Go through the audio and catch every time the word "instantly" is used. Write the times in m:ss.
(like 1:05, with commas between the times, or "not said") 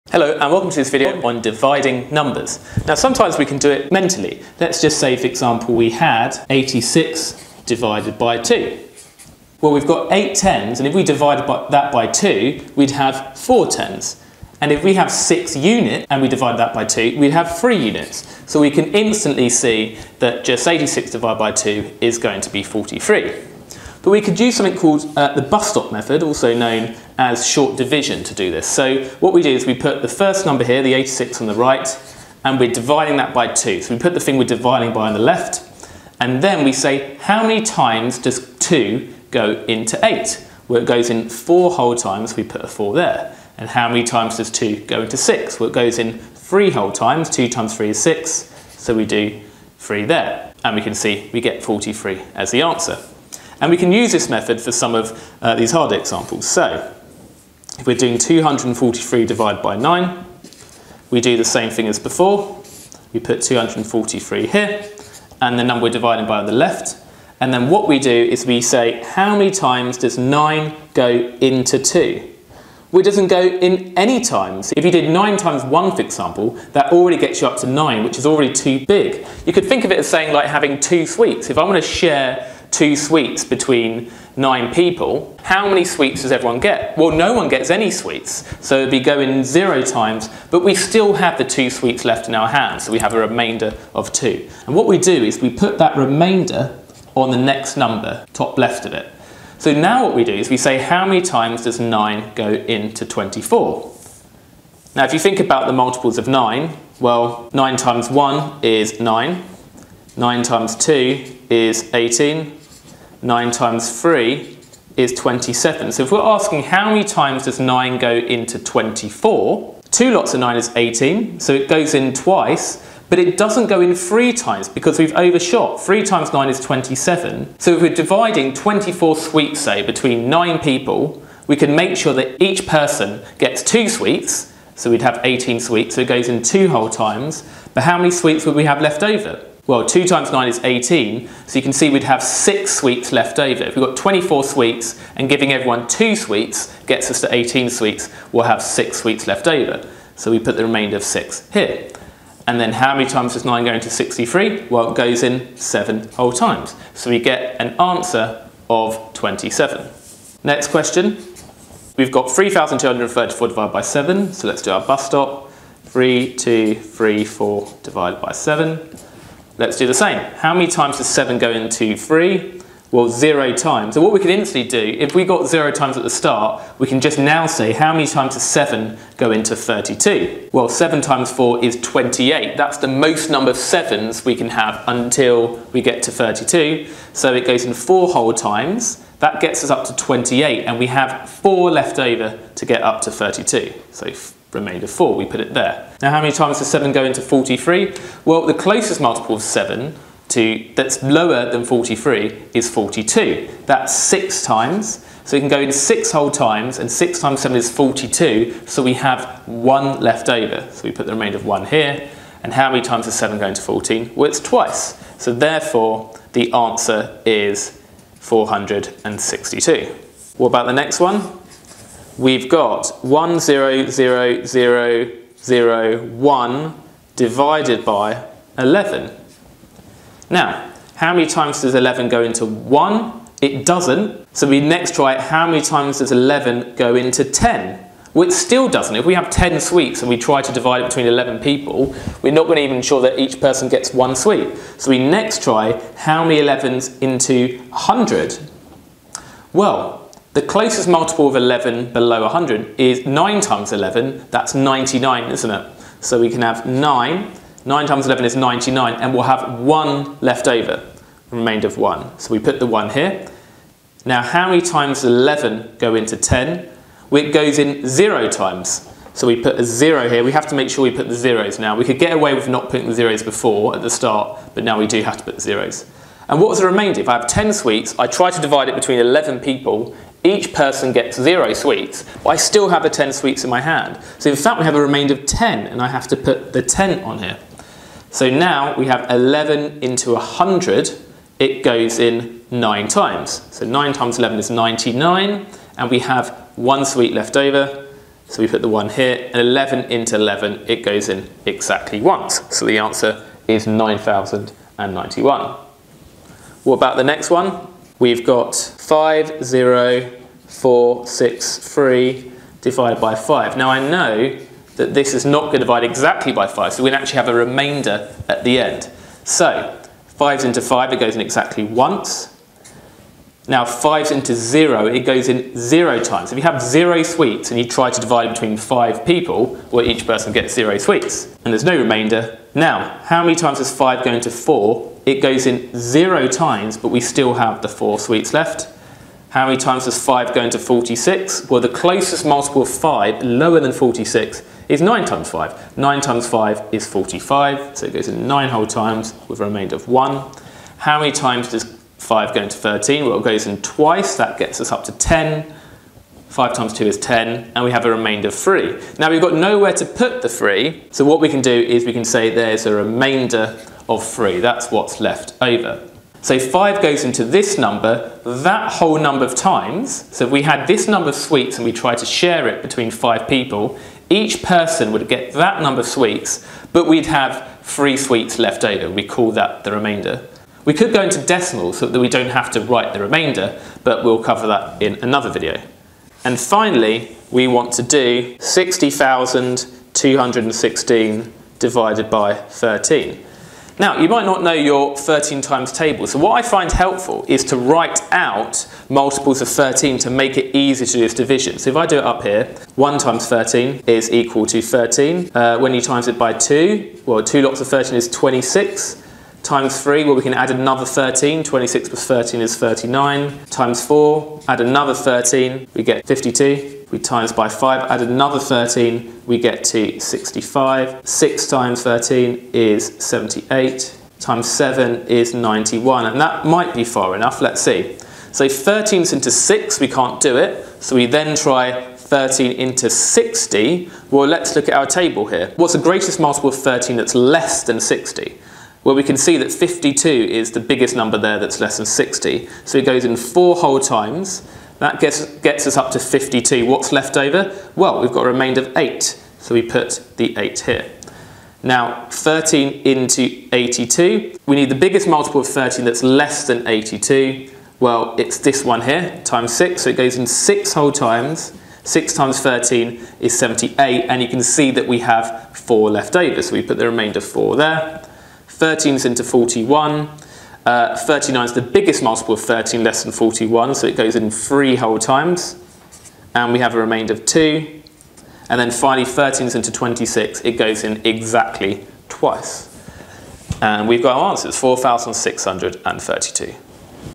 0:18, 2:54.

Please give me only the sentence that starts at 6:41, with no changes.
So if I do it up here, 1 times 13 is equal to 13.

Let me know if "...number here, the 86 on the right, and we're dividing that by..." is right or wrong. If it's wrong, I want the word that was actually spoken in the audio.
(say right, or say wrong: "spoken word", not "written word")
right.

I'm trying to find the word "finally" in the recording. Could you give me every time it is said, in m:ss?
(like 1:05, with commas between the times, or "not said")
6:26, 7:58.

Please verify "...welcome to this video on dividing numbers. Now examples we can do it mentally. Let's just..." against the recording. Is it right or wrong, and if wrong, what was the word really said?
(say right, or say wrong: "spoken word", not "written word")
wrong: "sometimes", not "examples".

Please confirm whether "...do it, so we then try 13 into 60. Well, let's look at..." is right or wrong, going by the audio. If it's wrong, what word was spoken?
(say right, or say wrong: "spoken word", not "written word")
right.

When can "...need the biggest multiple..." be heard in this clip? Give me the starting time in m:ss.
7:34.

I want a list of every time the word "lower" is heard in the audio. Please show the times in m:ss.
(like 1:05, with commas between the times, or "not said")
3:21, 5:43.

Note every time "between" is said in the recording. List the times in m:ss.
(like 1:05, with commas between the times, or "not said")
1:23, 2:09, 4:00, 4:38, 5:28, 6:12.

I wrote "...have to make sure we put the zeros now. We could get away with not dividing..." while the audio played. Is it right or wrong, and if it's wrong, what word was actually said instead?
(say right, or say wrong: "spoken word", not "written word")
wrong: "putting", not "dividing".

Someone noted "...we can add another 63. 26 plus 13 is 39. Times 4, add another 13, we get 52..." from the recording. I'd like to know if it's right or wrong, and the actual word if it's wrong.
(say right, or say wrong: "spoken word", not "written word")
wrong: "13", not "63".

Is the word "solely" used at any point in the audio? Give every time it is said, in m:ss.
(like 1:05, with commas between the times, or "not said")
not said.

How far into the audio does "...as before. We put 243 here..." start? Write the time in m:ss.
1:01.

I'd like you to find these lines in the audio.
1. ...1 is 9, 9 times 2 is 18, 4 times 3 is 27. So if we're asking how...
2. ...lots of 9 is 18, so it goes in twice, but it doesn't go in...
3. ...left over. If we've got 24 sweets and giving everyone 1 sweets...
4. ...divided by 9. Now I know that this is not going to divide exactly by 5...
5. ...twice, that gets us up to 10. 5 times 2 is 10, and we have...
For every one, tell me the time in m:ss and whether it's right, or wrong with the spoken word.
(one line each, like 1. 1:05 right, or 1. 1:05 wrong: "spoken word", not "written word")
1. 1:48 wrong: "9", not "4"
2. 2:00 right
3. 2:23 wrong: "2", not "1"
4. 5:12 wrong: "5", not "9"
5. 5:53 right.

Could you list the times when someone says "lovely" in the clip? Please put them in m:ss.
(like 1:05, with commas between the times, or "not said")
not said.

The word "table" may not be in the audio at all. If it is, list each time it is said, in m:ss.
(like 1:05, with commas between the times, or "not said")
6:35, 7:14.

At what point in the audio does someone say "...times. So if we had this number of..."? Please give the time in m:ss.
6:09.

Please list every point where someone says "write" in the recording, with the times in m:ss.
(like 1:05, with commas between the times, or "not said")
6:22, 6:37.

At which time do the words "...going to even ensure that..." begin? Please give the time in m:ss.
4:02.